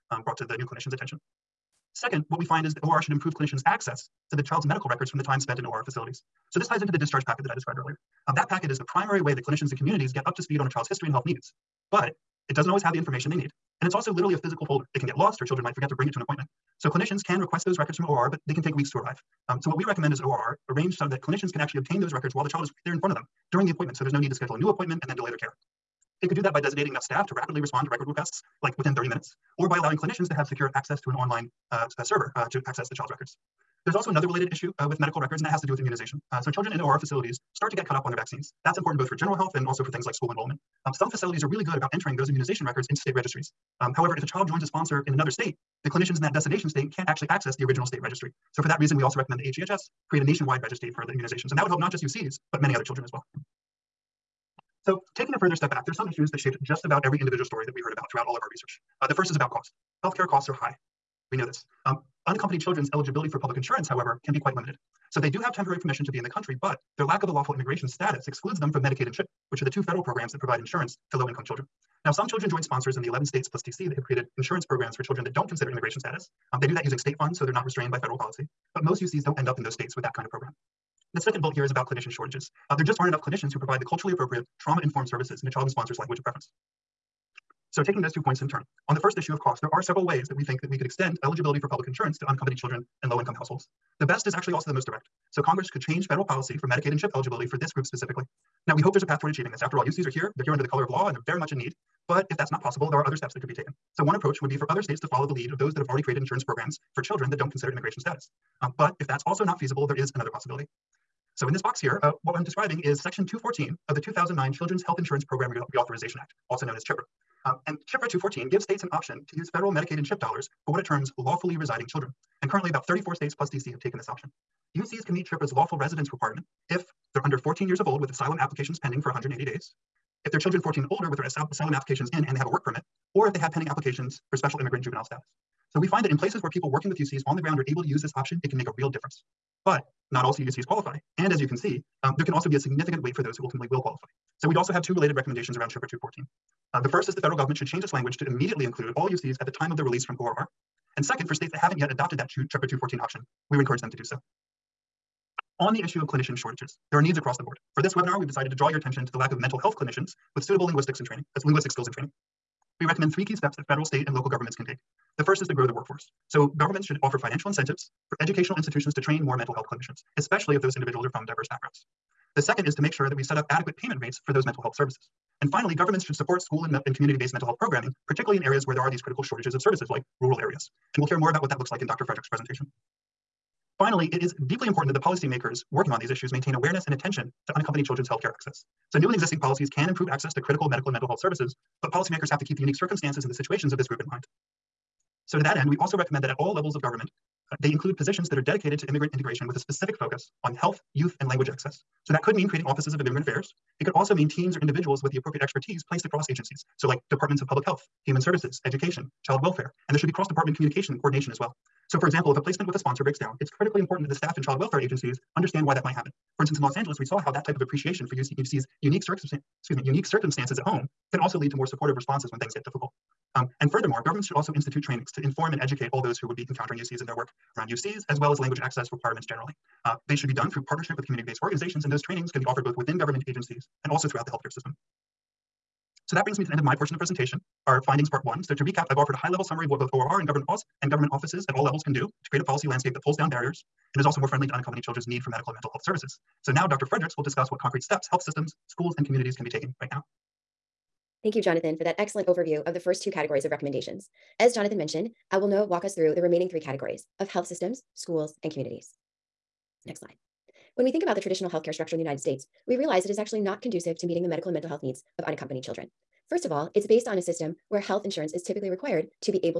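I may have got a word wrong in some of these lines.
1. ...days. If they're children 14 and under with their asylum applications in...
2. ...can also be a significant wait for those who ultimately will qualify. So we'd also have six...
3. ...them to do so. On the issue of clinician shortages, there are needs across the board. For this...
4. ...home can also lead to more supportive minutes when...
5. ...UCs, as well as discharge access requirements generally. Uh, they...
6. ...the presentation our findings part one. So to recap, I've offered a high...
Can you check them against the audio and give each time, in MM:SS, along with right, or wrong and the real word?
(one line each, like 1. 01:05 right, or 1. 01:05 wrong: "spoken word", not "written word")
1. 02:09 wrong: "older", not "under"
2. 02:22 wrong: "two", not "six"
3. 02:33 right
4. 03:40 wrong: "responses", not "minutes"
5. 03:47 wrong: "language", not "discharge"
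6. 03:56 right.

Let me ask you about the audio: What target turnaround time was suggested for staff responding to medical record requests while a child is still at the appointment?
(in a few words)
30 minutes.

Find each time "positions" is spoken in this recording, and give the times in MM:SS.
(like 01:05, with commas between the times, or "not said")
03:17.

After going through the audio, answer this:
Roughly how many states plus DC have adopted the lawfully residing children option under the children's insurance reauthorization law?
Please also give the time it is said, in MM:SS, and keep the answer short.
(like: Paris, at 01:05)
34, at 02:02.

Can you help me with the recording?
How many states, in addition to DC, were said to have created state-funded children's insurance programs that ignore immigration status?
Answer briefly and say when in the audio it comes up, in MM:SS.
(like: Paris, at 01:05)
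11, at 01:13.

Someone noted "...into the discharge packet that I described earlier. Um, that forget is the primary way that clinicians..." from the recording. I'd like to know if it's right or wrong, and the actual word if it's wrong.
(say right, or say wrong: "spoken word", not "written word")
wrong: "packet", not "forget".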